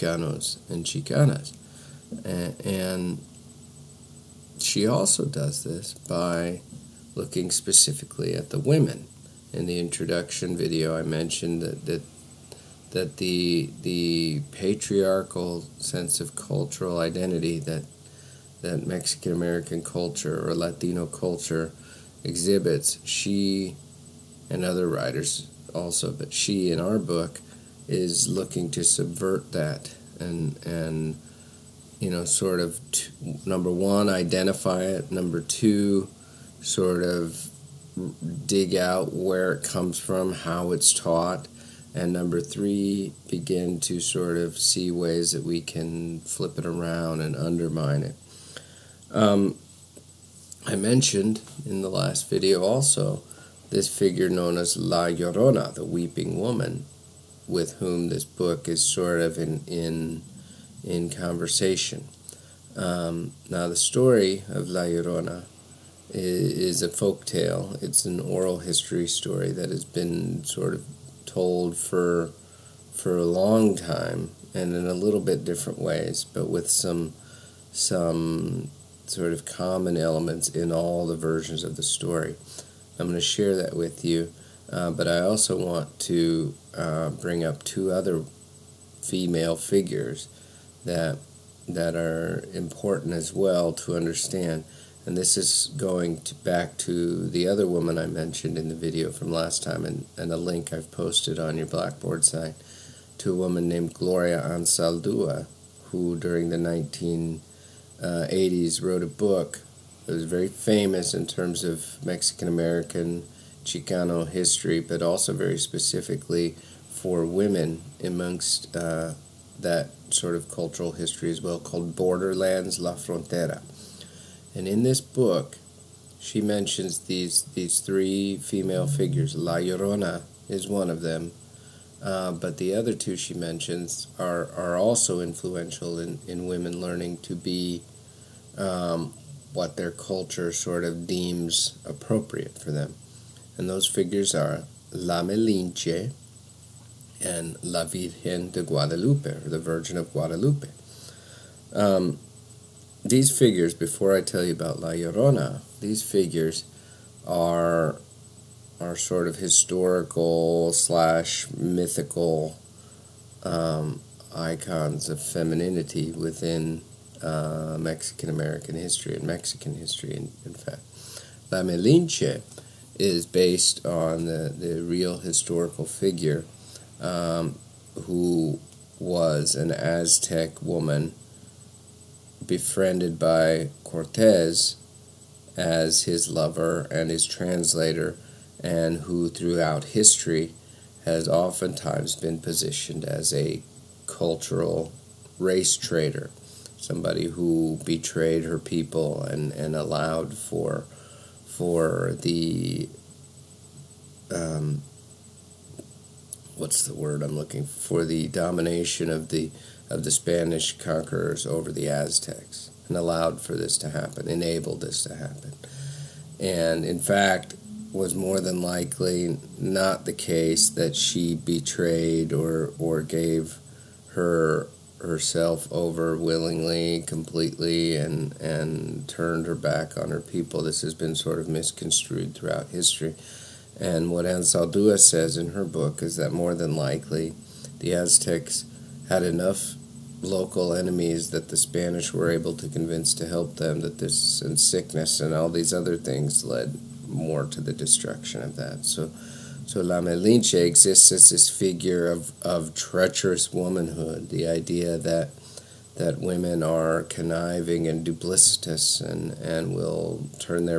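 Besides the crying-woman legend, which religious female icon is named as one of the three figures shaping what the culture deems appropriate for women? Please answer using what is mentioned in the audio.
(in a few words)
La Virgen de Guadalupe.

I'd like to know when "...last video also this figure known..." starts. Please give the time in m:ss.
0:51.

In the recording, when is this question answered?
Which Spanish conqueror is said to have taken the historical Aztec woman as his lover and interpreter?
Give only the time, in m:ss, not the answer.
3:03.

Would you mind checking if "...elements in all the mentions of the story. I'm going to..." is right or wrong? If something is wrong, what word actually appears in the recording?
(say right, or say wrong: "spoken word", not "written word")
wrong: "versions", not "mentions".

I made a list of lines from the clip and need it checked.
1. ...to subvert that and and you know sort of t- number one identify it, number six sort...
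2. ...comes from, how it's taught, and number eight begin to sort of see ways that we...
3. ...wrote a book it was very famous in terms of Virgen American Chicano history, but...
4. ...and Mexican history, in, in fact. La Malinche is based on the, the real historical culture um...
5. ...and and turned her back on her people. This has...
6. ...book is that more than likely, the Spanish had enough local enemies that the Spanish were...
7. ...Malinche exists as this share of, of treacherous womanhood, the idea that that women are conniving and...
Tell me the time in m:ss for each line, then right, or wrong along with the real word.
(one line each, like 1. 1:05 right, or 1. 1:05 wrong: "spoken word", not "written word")
1. 0:28 wrong: "two", not "six"
2. 0:39 wrong: "three", not "eight"
3. 1:48 wrong: "Mexican", not "Virgen"
4. 2:49 wrong: "figure", not "culture"
5. 3:47 right
6. 3:55 wrong: "Aztecs", not "Spanish"
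7. 4:10 wrong: "figure", not "share".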